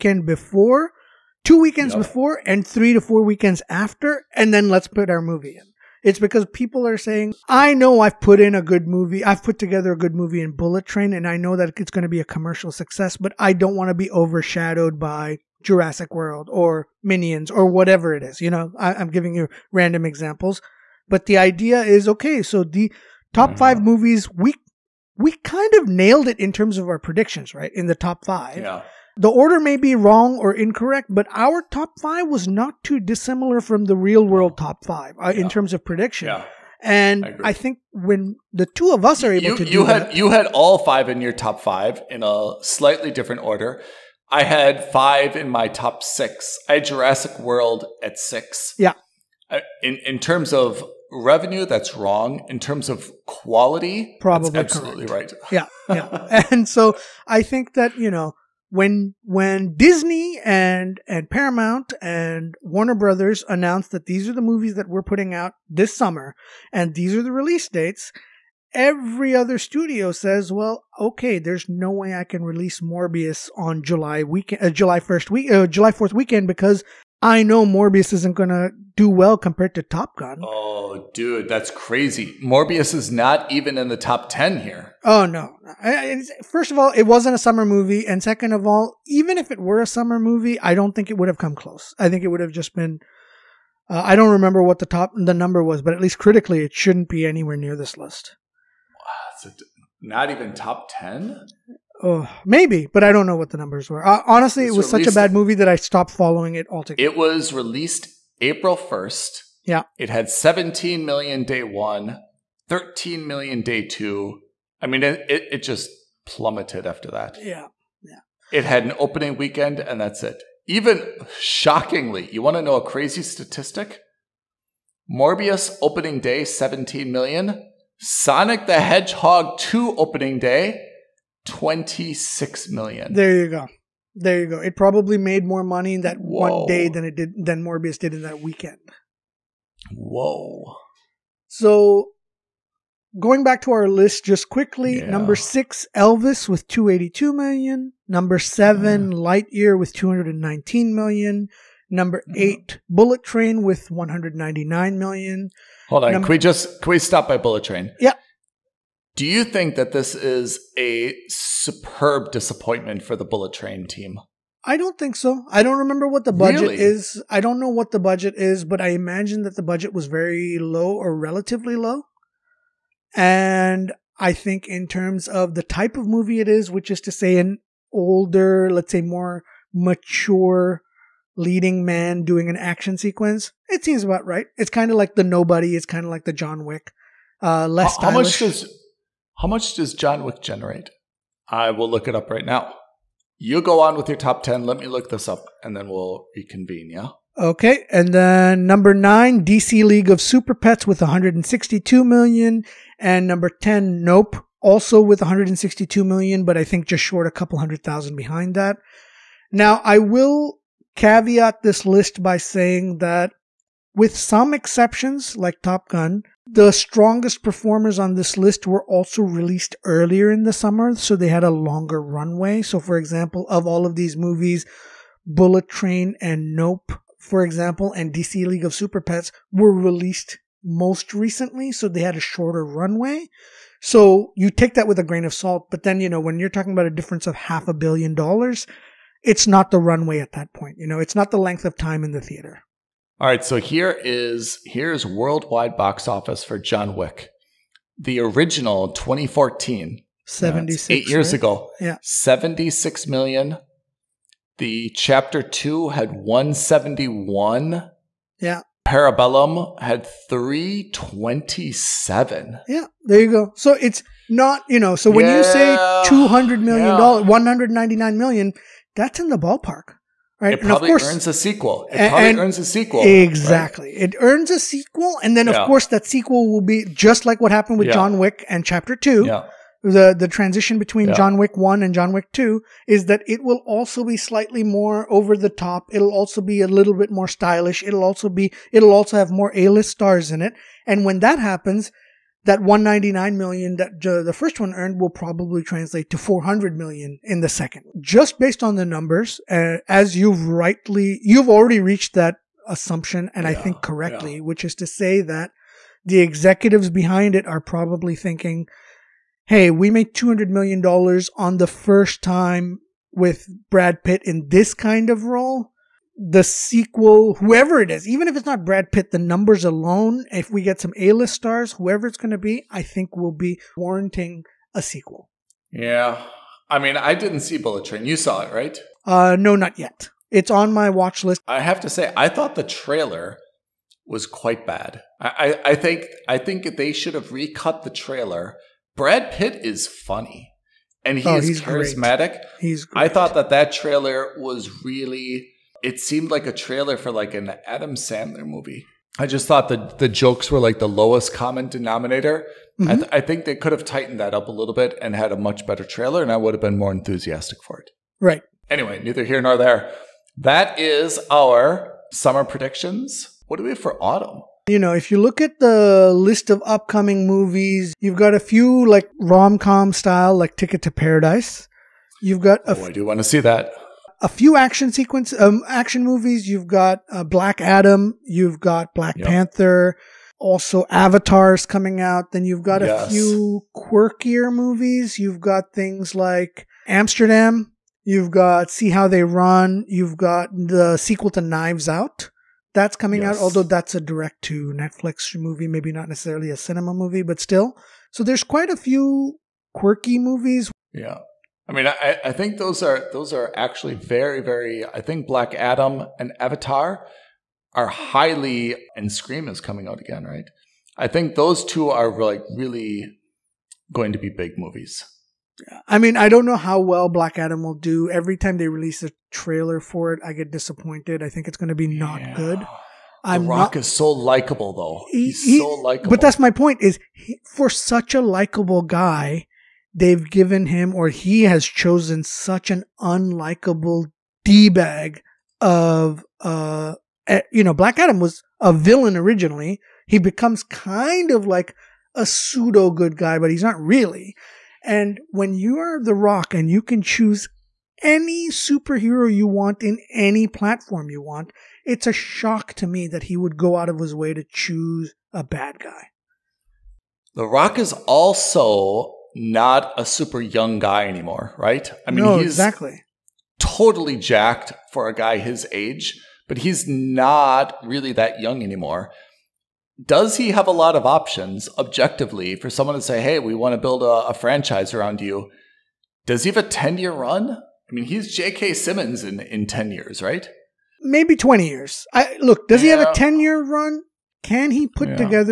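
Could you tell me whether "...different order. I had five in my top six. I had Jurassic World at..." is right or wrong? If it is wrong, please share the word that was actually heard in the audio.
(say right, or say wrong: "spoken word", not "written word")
right.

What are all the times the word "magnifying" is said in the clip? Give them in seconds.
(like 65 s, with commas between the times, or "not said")
not said.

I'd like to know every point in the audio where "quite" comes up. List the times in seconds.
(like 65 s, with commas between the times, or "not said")
334 s, 398 s.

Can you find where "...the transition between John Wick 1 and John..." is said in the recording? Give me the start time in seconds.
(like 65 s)
280 s.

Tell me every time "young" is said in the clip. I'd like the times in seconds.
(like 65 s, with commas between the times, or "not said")
460 s, 468 s.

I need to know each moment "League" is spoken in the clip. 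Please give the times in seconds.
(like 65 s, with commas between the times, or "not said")
199 s, 228 s.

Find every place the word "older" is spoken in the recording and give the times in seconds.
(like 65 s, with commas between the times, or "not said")
177 s.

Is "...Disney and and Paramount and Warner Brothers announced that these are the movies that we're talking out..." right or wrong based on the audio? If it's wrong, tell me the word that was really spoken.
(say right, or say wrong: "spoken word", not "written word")
wrong: "putting", not "talking".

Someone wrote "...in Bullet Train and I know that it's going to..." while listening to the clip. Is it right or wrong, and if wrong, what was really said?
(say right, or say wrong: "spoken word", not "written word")
right.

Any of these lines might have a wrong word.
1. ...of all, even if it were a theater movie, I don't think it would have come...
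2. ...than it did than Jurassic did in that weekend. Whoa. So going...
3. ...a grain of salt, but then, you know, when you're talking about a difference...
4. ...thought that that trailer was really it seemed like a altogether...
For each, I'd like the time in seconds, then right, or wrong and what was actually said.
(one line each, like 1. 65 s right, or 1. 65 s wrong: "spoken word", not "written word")
1. 88 s wrong: "summer", not "theater"
2. 136 s wrong: "Morbius", not "Jurassic"
3. 234 s right
4. 343 s wrong: "trailer", not "altogether".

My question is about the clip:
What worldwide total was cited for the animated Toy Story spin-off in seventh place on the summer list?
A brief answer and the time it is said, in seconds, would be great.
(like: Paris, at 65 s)
219 million, at 149 s.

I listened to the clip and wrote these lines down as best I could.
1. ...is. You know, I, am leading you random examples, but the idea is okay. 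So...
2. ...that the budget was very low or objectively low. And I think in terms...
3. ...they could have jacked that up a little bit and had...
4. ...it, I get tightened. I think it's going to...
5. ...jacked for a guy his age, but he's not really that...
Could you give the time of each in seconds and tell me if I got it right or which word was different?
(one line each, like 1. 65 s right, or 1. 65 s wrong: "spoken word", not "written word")
1. 18 s wrong: "giving", not "leading"
2. 169 s wrong: "relatively", not "objectively"
3. 353 s wrong: "tightened", not "jacked"
4. 420 s wrong: "disappointed", not "tightened"
5. 464 s right.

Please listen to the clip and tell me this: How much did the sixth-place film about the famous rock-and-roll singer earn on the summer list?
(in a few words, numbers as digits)
282 million.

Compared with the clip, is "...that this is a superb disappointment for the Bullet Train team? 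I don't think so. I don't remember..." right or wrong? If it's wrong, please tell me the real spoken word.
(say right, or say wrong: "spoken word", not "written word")
right.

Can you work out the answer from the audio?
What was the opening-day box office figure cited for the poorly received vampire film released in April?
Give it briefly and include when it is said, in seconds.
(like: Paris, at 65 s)
17 million, at 110 s.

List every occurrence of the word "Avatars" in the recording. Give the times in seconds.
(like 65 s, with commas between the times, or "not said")
380 s, 406 s.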